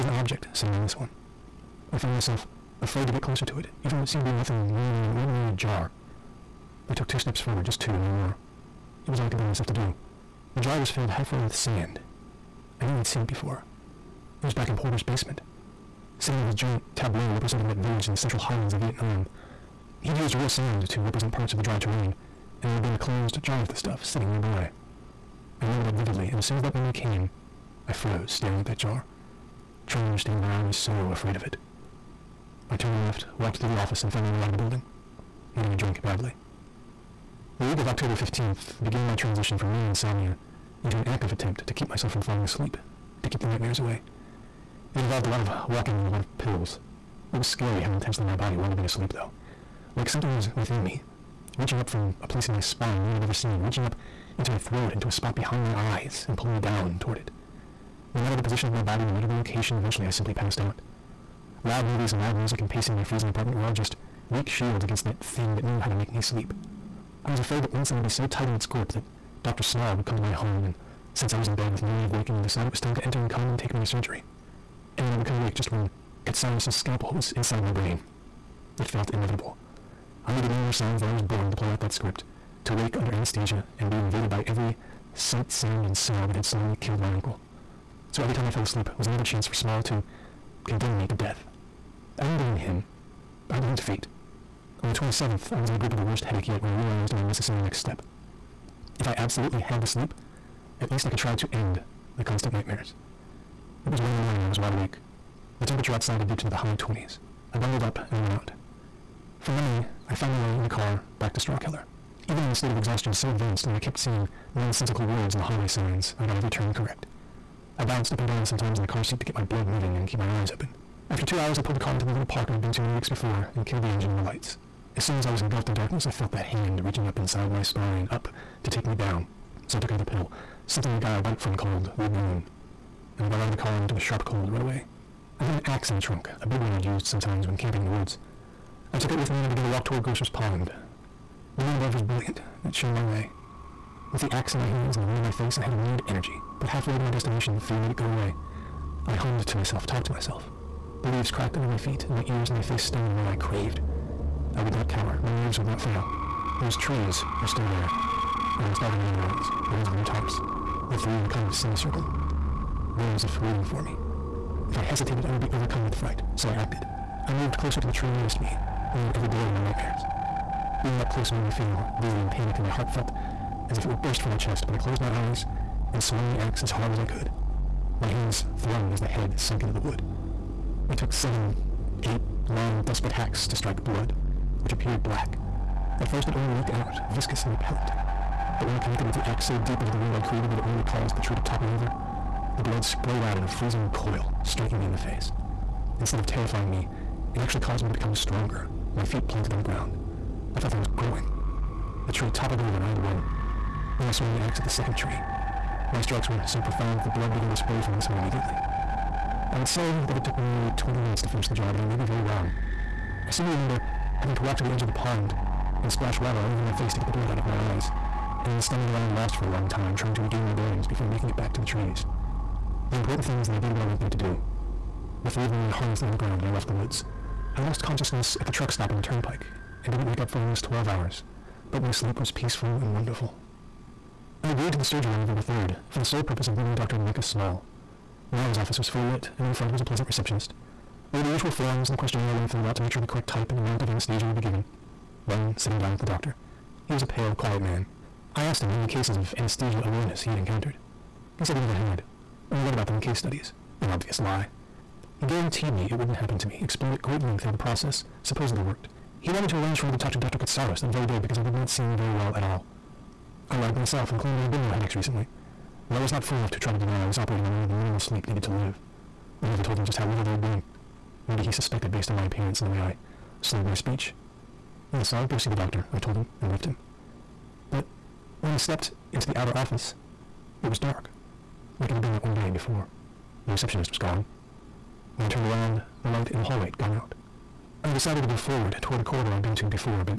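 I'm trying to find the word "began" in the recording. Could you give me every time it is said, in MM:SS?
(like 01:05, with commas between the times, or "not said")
00:38, 02:19, 03:27.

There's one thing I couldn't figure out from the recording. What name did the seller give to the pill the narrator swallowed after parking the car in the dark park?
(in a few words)
Lagoon.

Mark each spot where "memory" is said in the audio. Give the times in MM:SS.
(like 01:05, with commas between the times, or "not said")
00:26, 01:49.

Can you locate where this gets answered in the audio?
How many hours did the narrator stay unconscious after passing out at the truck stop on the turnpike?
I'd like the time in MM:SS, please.
03:50.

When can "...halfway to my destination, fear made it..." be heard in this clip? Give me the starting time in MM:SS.
02:26.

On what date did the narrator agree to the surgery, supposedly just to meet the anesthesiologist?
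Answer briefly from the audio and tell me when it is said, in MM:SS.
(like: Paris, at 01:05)
November 3rd, at 03:55.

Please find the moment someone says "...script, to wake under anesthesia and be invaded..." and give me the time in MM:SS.
01:21.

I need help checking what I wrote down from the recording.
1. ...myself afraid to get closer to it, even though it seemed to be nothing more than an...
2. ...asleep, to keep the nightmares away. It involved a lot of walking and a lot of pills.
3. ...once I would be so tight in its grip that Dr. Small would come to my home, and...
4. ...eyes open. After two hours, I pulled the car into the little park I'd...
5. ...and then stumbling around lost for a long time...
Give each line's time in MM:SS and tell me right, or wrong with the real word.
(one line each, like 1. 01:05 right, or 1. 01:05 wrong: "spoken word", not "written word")
1. 00:02 right
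2. 00:42 right
3. 01:07 right
4. 02:00 right
5. 03:38 right.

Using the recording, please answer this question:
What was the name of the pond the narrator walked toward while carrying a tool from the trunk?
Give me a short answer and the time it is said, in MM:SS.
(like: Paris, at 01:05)
Grocer's Pond, at 02:20.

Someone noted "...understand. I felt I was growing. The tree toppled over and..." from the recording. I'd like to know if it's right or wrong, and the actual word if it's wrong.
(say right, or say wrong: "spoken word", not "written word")
wrong: "ground", not "understand".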